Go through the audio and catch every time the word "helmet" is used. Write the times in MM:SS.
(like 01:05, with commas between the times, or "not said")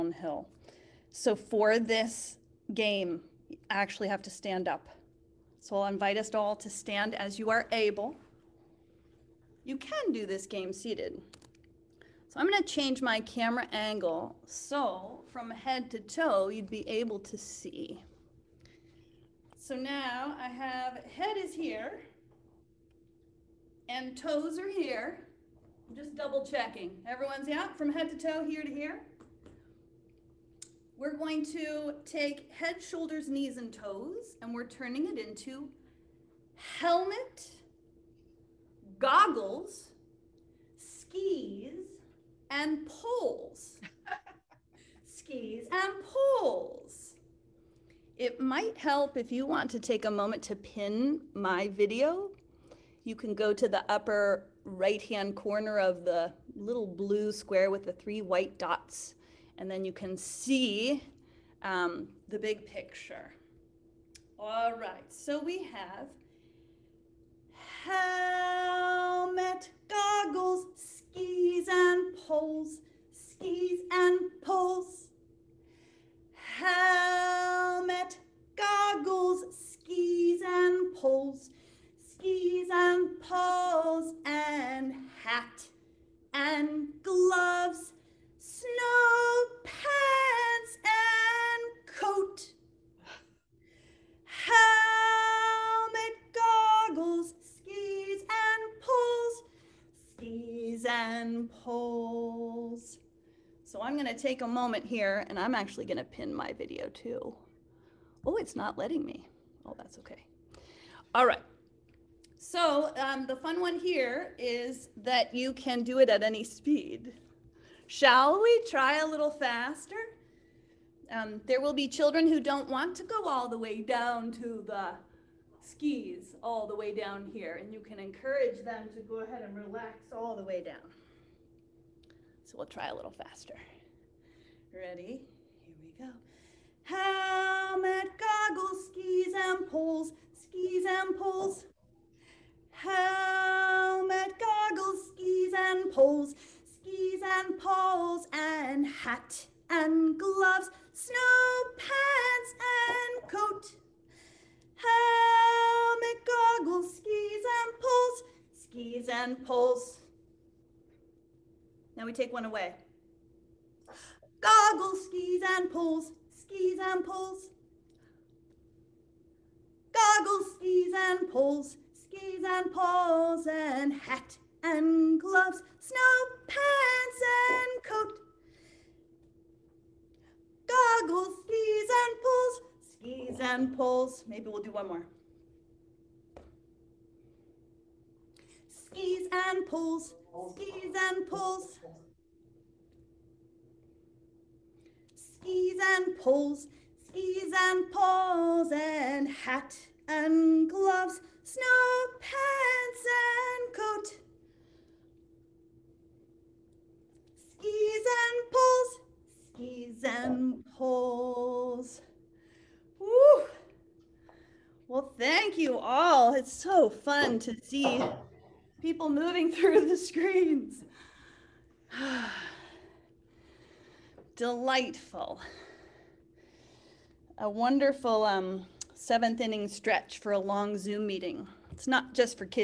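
00:36, 01:07, 01:16, 01:34, 02:16, 02:22, 02:34.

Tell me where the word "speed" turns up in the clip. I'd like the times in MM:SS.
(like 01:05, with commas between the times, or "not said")
01:56.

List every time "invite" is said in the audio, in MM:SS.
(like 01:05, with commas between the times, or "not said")
00:05.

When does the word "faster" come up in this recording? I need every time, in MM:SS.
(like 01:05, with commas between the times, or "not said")
01:59, 02:13.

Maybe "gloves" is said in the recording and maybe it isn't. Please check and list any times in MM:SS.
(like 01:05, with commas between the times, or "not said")
01:27, 02:30, 02:55, 03:20.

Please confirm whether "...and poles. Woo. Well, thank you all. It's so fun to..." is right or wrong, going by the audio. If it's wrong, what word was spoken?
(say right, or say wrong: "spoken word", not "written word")
right.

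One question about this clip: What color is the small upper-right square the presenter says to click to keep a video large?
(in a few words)
Blue.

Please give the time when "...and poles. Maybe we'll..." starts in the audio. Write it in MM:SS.
03:03.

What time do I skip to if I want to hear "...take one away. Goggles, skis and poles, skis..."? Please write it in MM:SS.
02:42.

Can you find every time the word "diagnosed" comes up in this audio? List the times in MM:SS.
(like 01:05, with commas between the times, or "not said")
not said.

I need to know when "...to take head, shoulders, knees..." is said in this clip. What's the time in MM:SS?
00:31.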